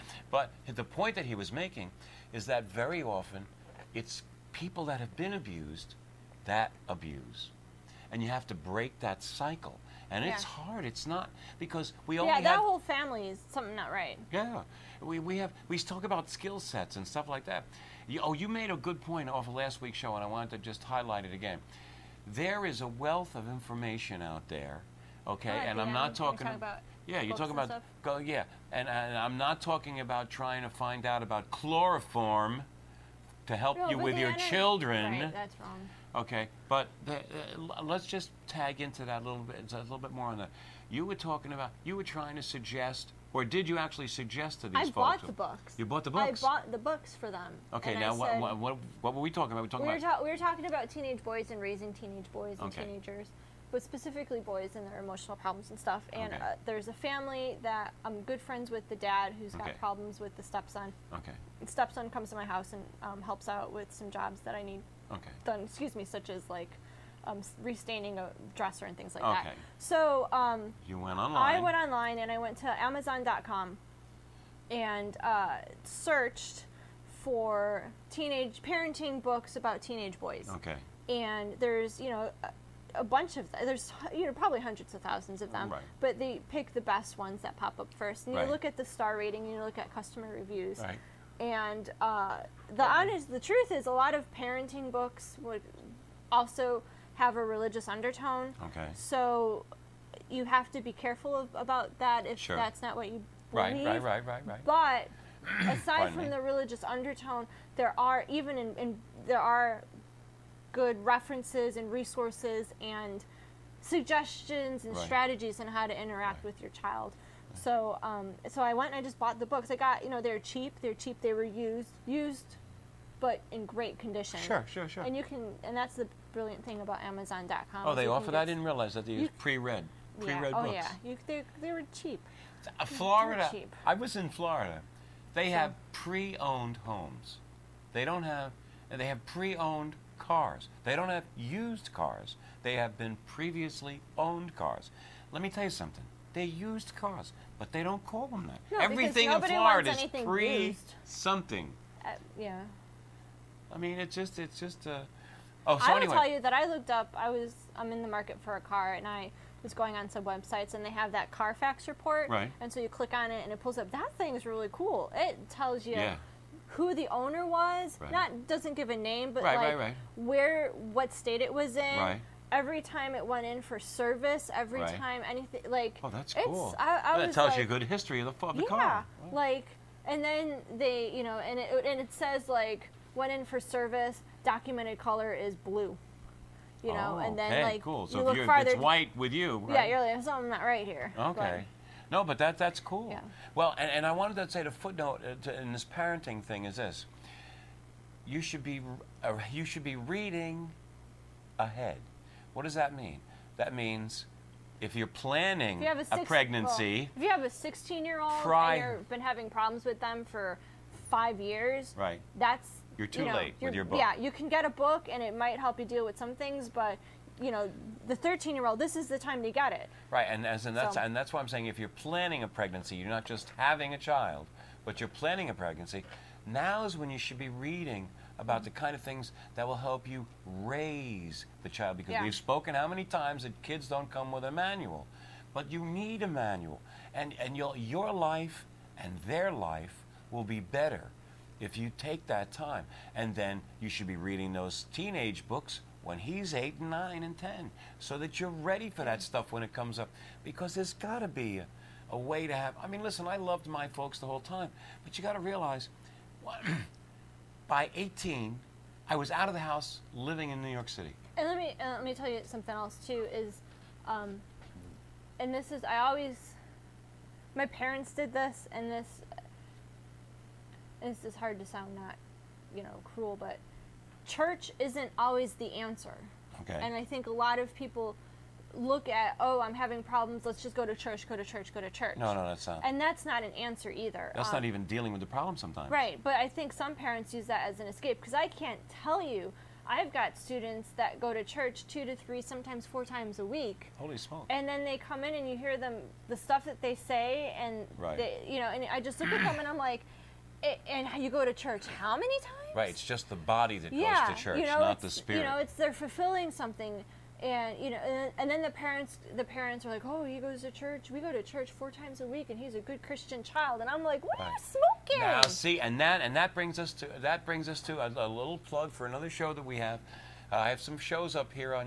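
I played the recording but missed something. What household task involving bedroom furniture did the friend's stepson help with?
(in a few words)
Restaining a dresser.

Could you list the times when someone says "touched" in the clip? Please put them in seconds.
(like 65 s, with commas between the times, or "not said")
not said.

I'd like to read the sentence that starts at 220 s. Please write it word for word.
Right, and as and that's so.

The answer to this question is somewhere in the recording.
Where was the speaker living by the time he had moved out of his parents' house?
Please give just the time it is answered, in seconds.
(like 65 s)
260 s.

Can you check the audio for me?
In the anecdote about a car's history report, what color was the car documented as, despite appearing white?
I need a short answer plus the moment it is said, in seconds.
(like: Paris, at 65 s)
Blue, at 185 s.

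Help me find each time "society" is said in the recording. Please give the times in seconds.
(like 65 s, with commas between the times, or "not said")
not said.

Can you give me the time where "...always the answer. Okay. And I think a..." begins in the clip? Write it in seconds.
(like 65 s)
275 s.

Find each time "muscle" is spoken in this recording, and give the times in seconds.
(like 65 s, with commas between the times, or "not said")
not said.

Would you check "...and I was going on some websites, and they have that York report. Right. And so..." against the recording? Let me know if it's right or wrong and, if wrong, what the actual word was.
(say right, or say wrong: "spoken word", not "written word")
wrong: "Carfax", not "York".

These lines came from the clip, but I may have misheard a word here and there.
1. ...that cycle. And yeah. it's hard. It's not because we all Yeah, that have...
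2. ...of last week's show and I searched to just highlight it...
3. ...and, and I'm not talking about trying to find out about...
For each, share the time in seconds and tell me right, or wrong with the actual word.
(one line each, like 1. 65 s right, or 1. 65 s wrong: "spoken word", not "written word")
1. 8 s right
2. 19 s wrong: "wanted", not "searched"
3. 28 s right.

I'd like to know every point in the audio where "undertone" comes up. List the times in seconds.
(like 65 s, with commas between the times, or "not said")
97 s, 106 s.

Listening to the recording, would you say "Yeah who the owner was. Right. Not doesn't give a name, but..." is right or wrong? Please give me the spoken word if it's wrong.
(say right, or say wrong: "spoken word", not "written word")
right.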